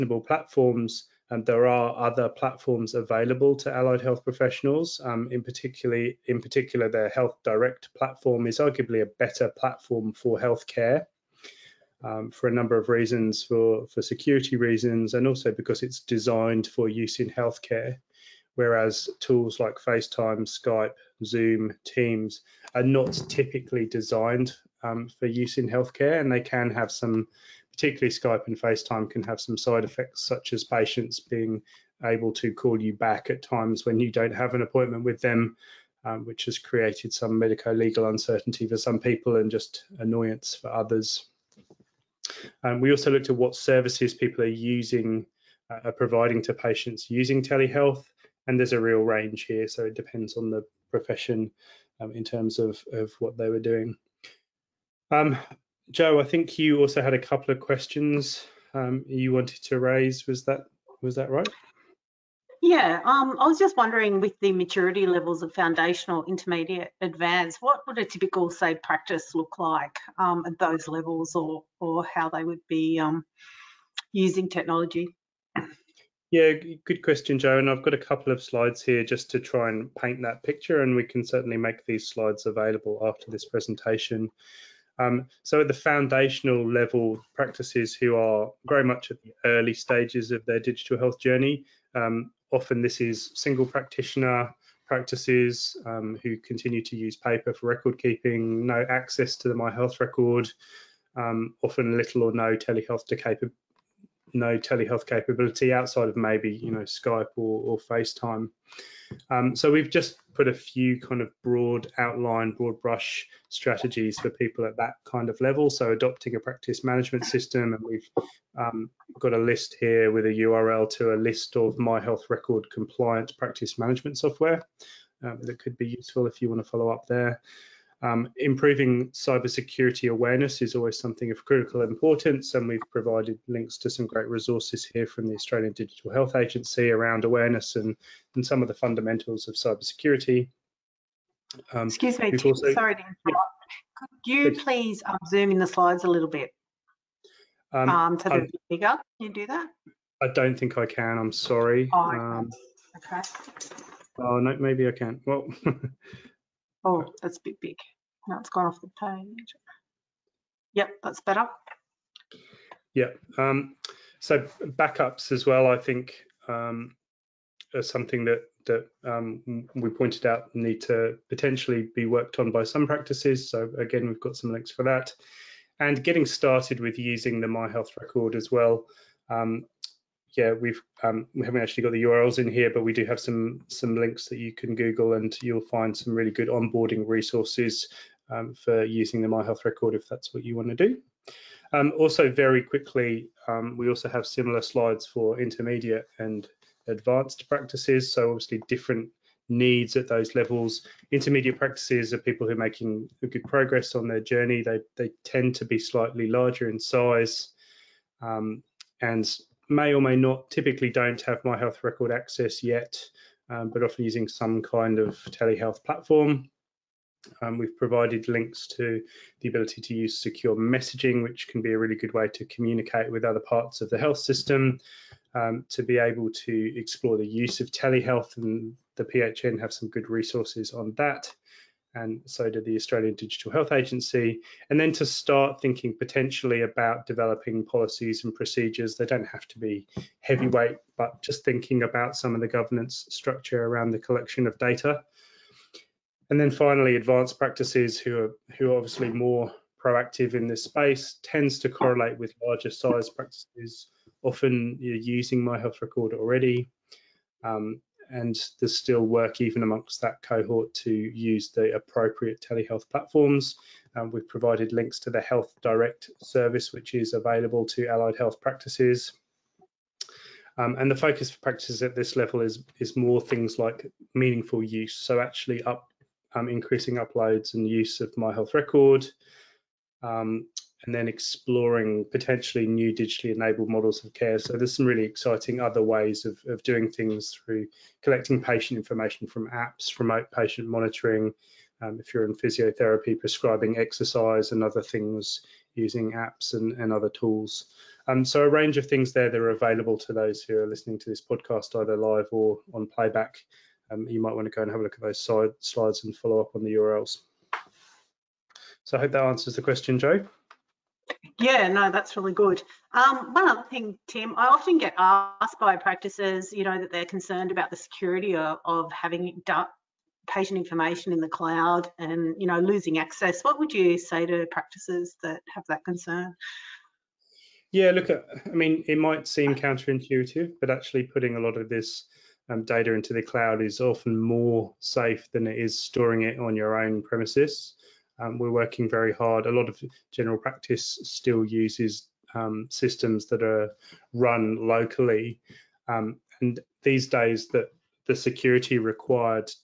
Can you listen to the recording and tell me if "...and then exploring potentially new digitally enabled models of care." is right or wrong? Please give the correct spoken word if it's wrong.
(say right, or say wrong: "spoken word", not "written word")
right.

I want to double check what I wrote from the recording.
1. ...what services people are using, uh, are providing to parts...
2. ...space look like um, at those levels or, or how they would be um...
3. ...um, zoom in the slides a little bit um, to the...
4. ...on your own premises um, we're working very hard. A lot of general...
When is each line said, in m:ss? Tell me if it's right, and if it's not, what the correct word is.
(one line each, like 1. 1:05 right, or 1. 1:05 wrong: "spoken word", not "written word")
1. 0:43 wrong: "patients", not "parts"
2. 1:08 wrong: "practice", not "space"
3. 2:25 right
4. 5:36 right.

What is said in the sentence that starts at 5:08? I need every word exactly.
So I hope that answers the question, Joe.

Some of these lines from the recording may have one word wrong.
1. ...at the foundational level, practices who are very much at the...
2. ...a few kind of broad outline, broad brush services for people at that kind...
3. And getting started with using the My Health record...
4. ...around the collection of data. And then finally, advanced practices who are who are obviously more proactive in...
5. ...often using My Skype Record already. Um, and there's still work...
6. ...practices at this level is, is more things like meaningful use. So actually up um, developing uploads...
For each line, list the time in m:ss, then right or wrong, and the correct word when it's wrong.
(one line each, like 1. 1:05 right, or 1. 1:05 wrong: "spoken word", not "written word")
1. 1:25 right
2. 1:50 wrong: "strategies", not "services"
3. 2:55 right
4. 4:03 right
5. 4:14 wrong: "Health", not "Skype"
6. 4:31 wrong: "increasing", not "developing".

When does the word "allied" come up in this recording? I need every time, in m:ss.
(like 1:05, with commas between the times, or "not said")
0:03, 4:27.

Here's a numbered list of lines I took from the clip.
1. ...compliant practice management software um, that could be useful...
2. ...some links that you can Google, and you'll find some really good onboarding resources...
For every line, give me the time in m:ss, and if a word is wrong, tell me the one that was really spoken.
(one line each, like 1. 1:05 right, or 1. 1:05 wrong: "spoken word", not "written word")
1. 2:02 right
2. 3:03 right.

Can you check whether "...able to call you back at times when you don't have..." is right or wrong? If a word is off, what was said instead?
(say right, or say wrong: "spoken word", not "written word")
right.